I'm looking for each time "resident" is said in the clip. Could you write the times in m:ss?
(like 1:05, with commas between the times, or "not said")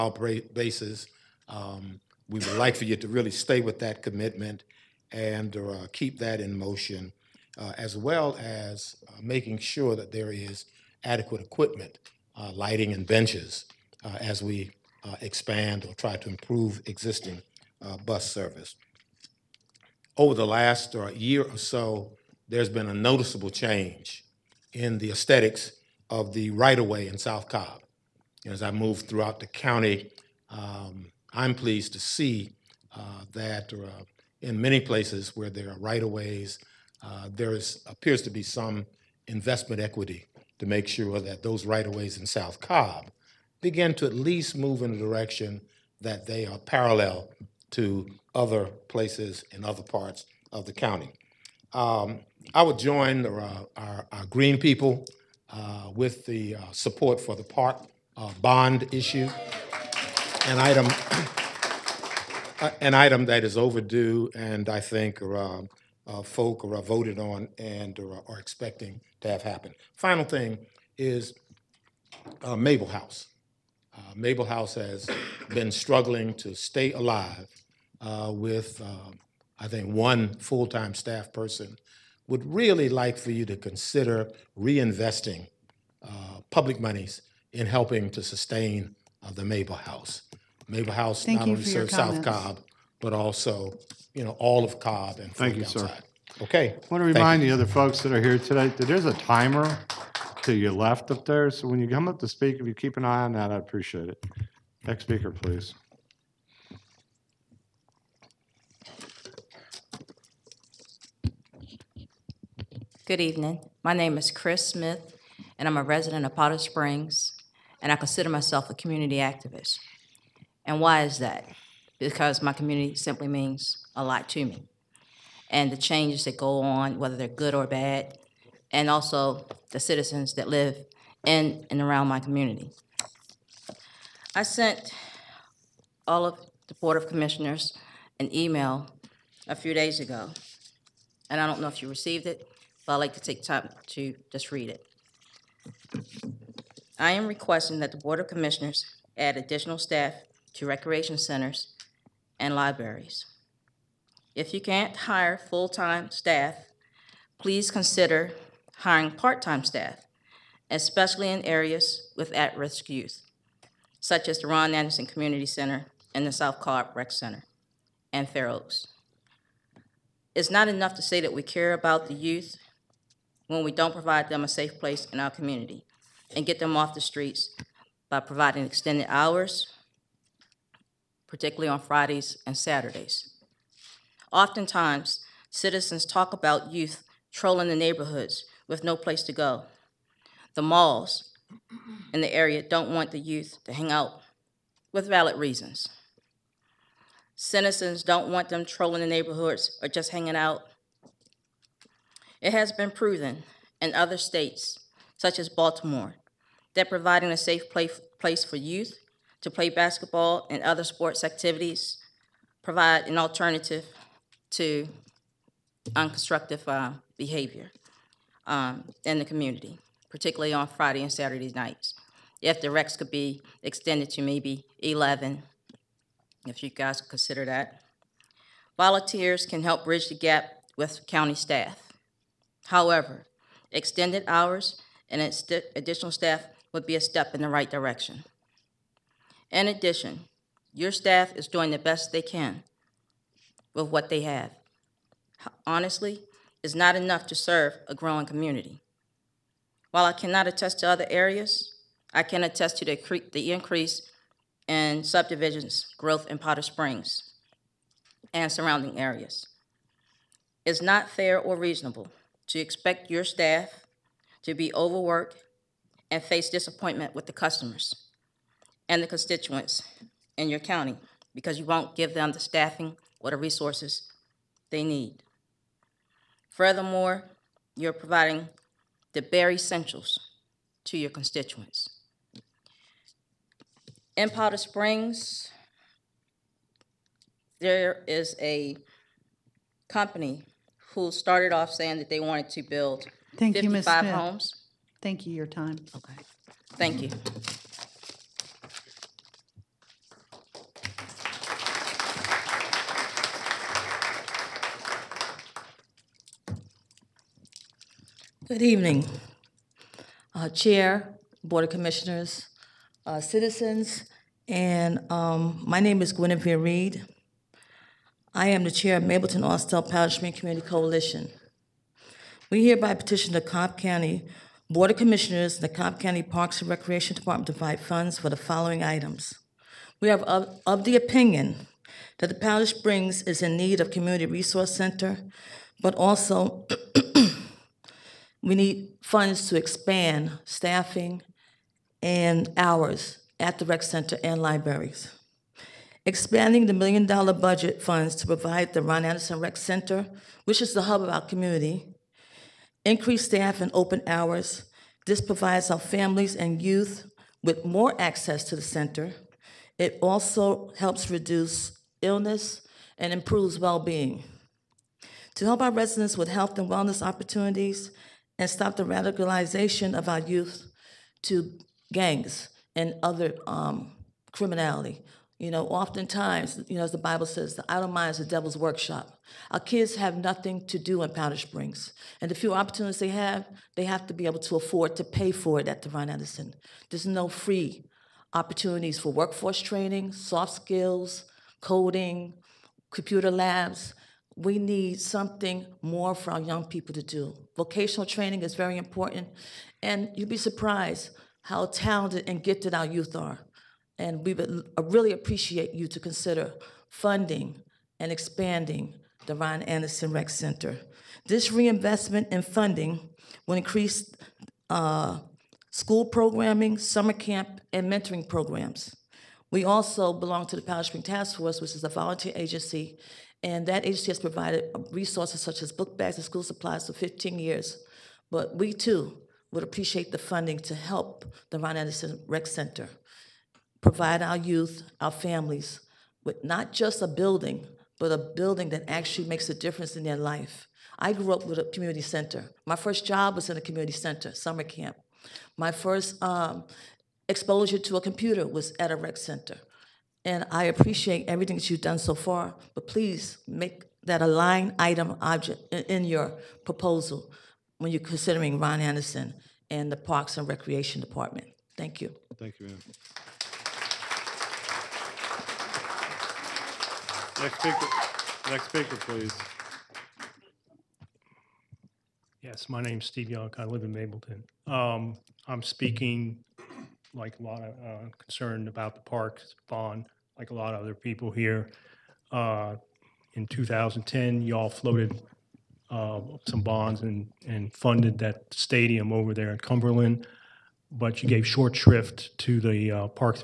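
1:55, 6:05.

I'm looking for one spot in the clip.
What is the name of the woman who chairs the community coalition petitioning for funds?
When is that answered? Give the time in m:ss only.
5:16.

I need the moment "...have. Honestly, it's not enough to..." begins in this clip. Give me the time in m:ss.
4:04.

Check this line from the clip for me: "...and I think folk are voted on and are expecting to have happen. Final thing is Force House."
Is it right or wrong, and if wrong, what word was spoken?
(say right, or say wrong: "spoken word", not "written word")
wrong: "Mable", not "Force".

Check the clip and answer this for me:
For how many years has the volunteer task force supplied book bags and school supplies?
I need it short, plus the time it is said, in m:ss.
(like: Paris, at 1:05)
15, at 7:06.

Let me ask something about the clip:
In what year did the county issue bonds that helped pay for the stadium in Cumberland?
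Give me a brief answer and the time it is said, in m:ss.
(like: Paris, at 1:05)
2010, at 8:03.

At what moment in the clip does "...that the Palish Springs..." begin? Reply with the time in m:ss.
5:32.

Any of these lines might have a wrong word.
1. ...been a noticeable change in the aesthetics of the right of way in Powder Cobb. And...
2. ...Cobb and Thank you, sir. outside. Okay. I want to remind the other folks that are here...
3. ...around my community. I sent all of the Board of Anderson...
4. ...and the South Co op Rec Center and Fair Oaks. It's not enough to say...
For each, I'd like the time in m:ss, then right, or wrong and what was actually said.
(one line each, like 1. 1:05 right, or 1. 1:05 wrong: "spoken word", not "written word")
1. 0:22 wrong: "South", not "Powder"
2. 1:34 right
3. 2:11 wrong: "Commissioners", not "Anderson"
4. 2:46 right.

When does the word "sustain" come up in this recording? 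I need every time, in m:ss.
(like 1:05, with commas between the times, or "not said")
1:28.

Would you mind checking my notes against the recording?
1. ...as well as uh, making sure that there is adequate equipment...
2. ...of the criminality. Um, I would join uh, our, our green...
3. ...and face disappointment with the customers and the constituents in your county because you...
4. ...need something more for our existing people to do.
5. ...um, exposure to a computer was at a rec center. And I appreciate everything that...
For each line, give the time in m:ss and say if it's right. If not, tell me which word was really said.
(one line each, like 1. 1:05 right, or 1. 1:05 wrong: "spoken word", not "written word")
1. 0:07 right
2. 0:50 wrong: "county", not "criminality"
3. 4:26 right
4. 6:34 wrong: "young", not "existing"
5. 7:26 right.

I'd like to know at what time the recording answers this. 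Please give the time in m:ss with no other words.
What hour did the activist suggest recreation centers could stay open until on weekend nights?
3:44.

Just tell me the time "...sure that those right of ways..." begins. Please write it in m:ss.
0:40.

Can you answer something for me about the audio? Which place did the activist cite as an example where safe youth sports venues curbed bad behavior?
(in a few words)
Baltimore.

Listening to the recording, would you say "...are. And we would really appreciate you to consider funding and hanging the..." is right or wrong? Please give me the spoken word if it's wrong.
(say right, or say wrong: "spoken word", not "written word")
wrong: "expanding", not "hanging".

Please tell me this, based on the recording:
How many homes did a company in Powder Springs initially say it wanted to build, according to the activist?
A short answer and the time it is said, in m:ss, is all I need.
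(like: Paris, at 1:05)
55, at 4:53.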